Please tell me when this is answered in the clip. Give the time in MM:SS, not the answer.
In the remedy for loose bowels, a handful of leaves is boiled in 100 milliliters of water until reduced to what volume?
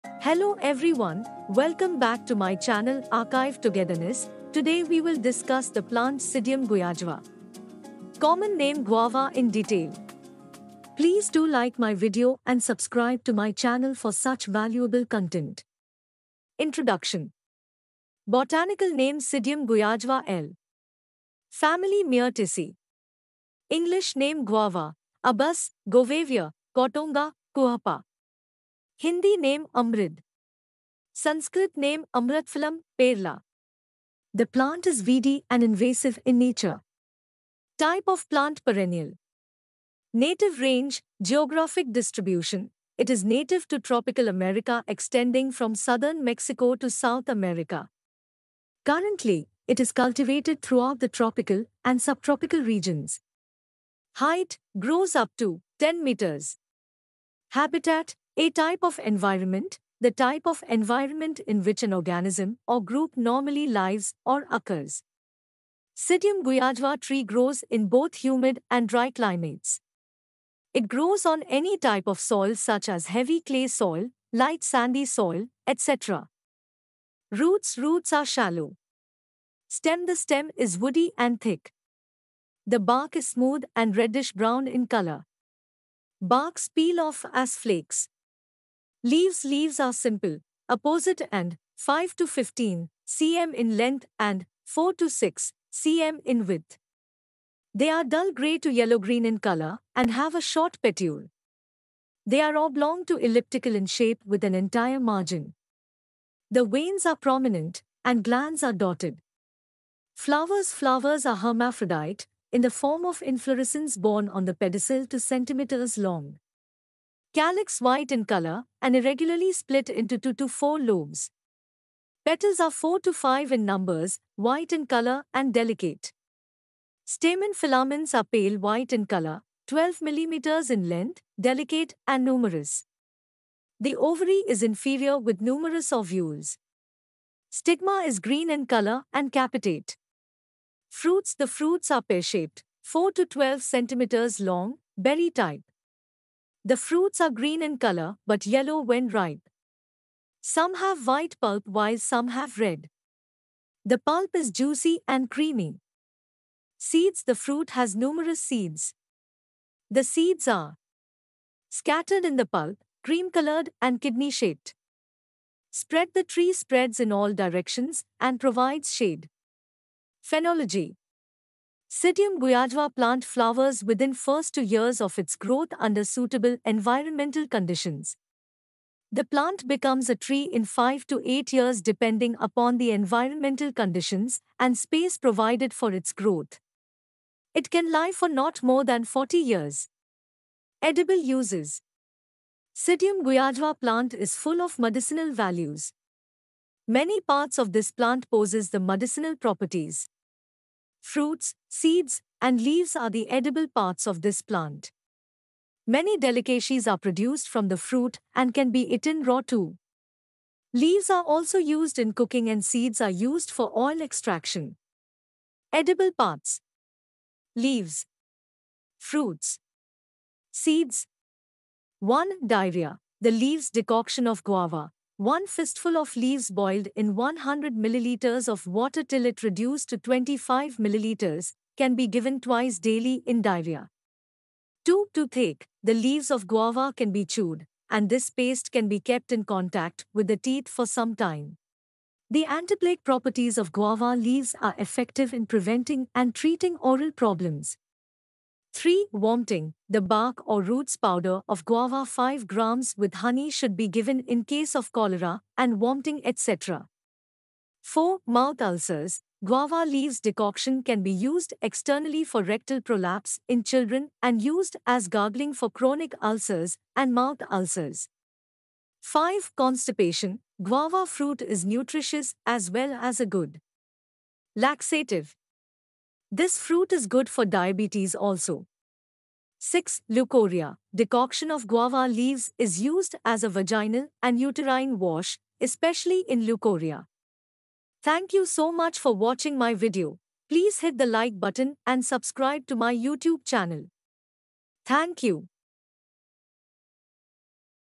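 03:49.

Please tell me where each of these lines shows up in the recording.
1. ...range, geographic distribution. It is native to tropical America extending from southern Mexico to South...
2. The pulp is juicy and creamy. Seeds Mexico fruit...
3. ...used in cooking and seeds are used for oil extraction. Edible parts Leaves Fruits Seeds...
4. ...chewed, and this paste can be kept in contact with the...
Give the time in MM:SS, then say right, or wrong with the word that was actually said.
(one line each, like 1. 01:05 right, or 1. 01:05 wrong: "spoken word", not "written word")
1. 00:40 right
2. 02:33 wrong: "The", not "Mexico"
3. 03:31 right
4. 03:57 right.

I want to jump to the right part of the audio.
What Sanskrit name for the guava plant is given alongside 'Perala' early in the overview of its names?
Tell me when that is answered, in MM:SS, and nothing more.
00:32.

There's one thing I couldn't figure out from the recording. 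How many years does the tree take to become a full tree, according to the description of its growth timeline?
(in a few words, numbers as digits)
5 to 8 years.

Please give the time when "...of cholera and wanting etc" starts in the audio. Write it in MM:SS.
04:14.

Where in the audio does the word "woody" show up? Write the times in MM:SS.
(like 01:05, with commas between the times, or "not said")
01:20.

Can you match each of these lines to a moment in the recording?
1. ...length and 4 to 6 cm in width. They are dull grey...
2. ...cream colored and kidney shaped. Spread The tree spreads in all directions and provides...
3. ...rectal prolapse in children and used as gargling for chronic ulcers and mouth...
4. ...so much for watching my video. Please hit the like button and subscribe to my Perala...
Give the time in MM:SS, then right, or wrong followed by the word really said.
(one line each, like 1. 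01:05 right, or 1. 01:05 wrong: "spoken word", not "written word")
1. 01:33 right
2. 02:43 right
3. 04:22 right
4. 04:48 wrong: "YouTube", not "Perala".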